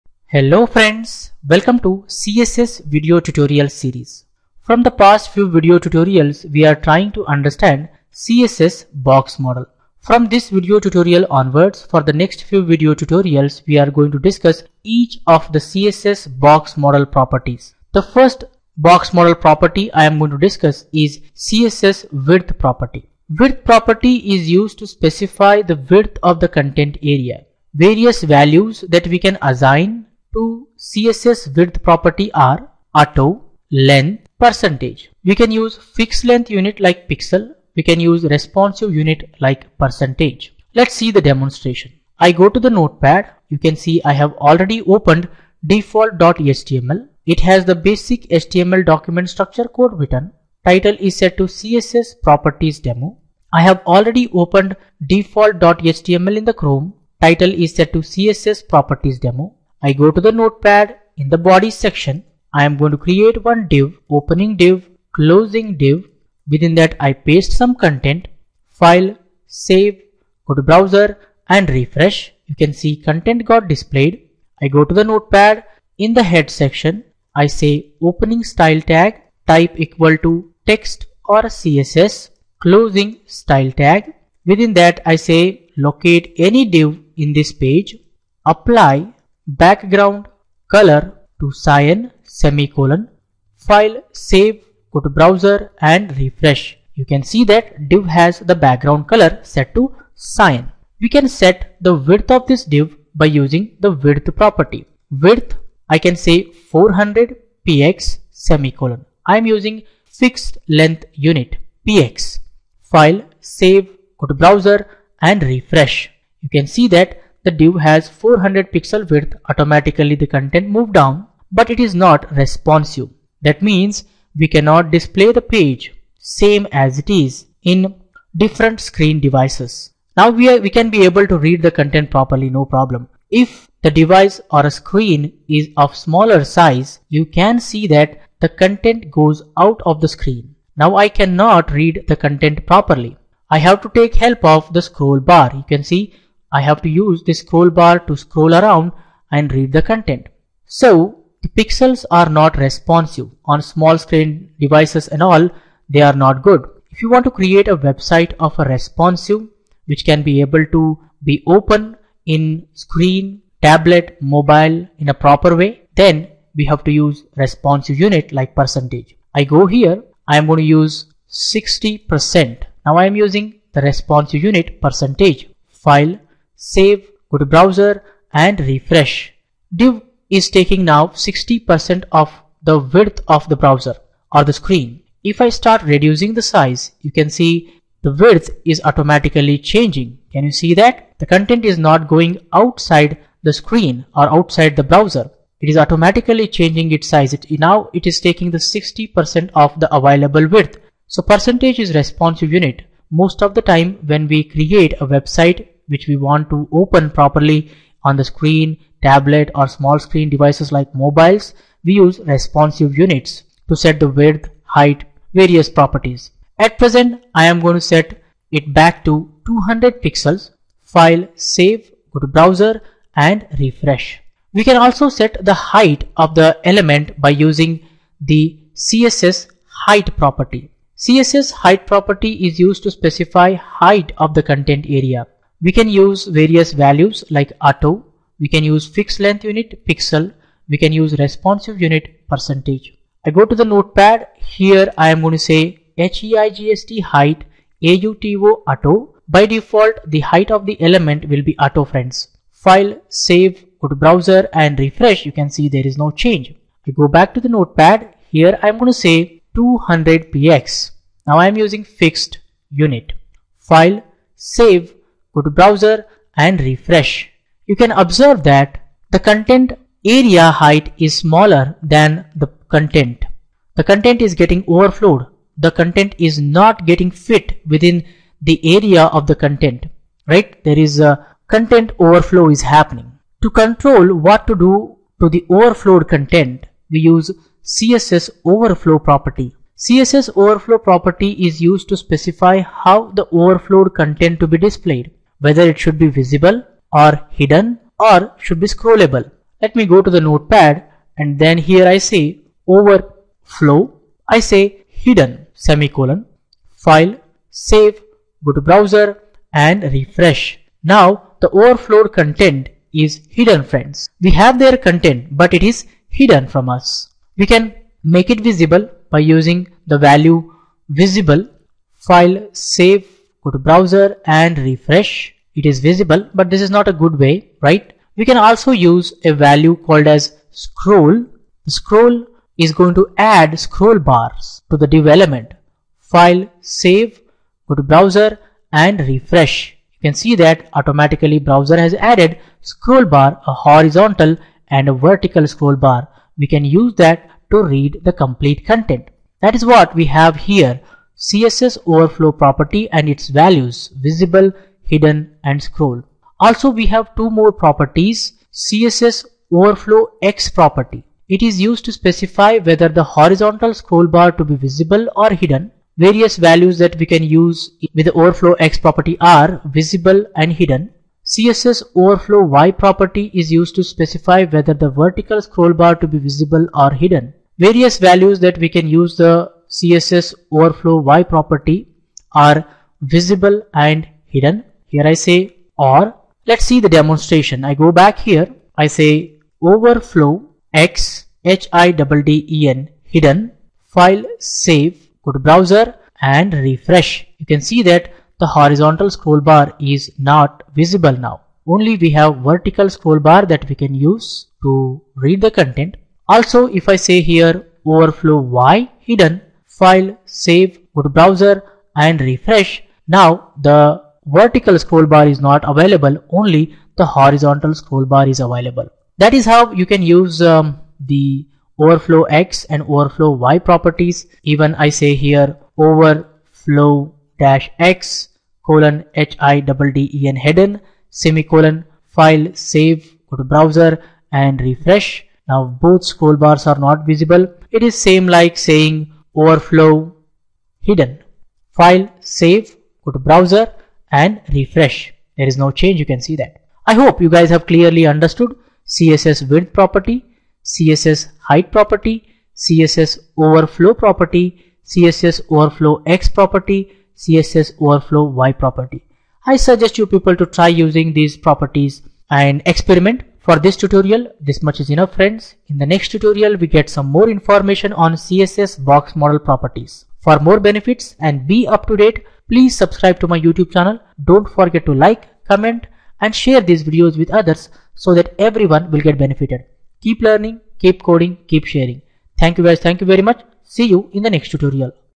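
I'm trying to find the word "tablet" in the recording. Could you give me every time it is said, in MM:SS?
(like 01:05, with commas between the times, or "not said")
02:43, 03:29.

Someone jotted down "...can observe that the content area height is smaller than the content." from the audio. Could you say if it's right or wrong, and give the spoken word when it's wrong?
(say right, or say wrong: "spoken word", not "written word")
right.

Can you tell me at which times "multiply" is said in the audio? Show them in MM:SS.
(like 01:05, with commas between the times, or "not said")
not said.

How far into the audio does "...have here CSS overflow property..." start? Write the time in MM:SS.
05:50.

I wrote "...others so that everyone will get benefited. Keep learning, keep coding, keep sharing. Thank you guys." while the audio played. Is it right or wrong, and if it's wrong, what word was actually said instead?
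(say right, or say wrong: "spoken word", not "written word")
right.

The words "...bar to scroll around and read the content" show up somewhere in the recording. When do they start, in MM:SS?
02:27.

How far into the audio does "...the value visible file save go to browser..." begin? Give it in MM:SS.
05:19.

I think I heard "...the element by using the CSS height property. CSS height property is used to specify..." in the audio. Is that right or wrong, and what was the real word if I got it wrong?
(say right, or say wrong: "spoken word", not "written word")
right.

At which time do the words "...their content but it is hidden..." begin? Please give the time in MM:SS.
05:14.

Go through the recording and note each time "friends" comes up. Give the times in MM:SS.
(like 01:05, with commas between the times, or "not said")
00:00, 04:11, 05:13, 07:45.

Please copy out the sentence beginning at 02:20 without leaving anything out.
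Now I cannot read the content properly.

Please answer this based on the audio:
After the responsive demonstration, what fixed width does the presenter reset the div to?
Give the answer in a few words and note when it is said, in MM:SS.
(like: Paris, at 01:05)
200 pixels, at 03:39.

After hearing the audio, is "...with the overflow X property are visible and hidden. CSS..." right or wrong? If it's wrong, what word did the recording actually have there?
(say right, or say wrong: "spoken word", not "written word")
right.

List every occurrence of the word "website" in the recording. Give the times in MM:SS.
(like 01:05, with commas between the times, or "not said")
02:37, 03:25.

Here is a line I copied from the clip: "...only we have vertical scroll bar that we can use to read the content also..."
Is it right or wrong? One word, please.
right.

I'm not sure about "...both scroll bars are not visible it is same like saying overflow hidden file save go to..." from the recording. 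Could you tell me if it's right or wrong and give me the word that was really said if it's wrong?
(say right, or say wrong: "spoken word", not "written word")
right.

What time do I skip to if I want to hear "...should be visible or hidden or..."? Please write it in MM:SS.
04:55.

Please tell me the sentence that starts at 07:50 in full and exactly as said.
For more benefits and be up to date, please subscribe to my YouTube channel.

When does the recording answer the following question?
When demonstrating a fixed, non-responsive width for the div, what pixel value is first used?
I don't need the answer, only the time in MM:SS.
01:46.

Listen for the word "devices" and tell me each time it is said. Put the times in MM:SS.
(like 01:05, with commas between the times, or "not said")
02:09, 02:13, 02:34, 03:30.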